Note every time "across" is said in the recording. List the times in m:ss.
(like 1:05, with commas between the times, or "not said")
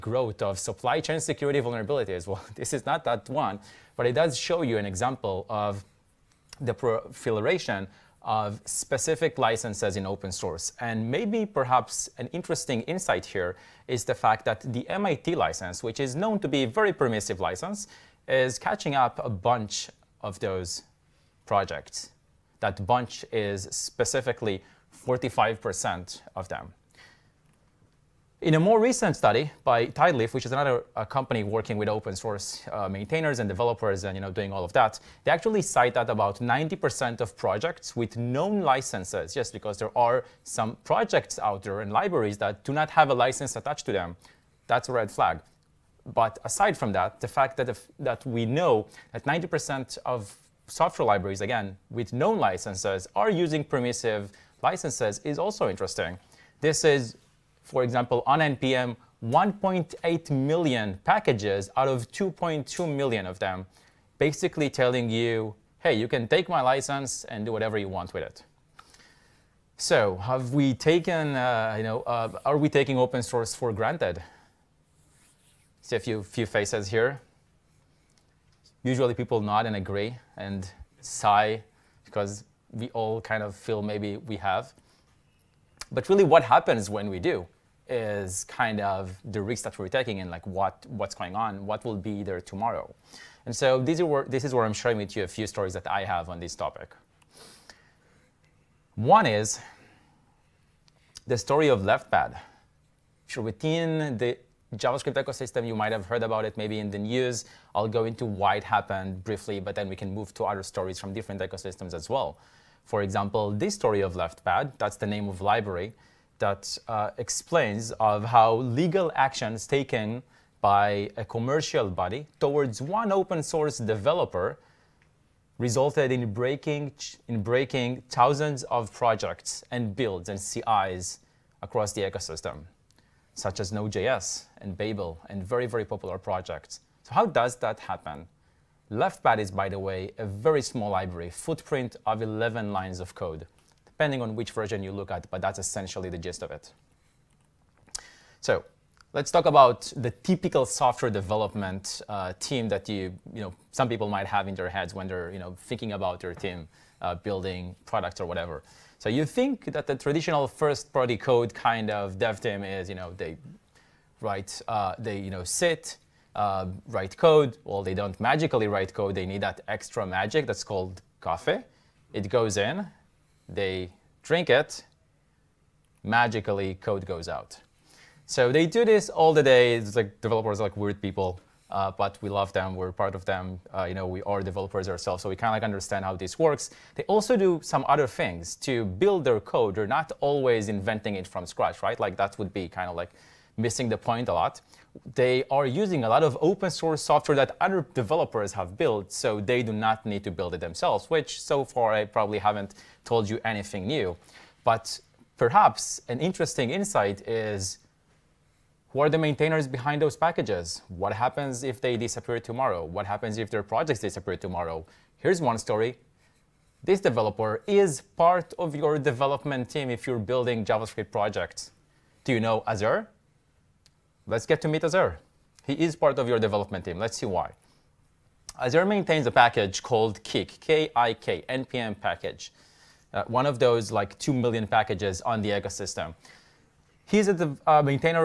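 2:11.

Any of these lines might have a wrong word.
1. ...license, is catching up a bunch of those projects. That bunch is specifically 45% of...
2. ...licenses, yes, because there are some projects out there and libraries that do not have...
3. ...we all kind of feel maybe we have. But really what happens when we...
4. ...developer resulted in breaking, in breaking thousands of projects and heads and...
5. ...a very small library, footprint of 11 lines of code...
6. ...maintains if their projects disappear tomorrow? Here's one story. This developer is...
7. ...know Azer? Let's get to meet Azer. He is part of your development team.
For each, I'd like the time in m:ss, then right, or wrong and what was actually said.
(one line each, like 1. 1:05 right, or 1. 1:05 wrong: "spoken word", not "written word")
1. 0:17 right
2. 0:38 right
3. 1:22 right
4. 2:03 wrong: "builds", not "heads"
5. 2:20 right
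6. 3:33 wrong: "happens", not "maintains"
7. 3:42 right.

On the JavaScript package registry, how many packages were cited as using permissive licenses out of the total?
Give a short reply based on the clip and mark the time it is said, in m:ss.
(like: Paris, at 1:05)
1.8 million, at 0:59.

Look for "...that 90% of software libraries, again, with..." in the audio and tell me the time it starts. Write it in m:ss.
0:49.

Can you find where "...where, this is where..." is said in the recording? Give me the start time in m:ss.
1:34.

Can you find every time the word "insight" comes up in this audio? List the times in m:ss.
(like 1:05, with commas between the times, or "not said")
0:12, 3:26.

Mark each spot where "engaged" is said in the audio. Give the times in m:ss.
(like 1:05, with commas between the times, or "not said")
not said.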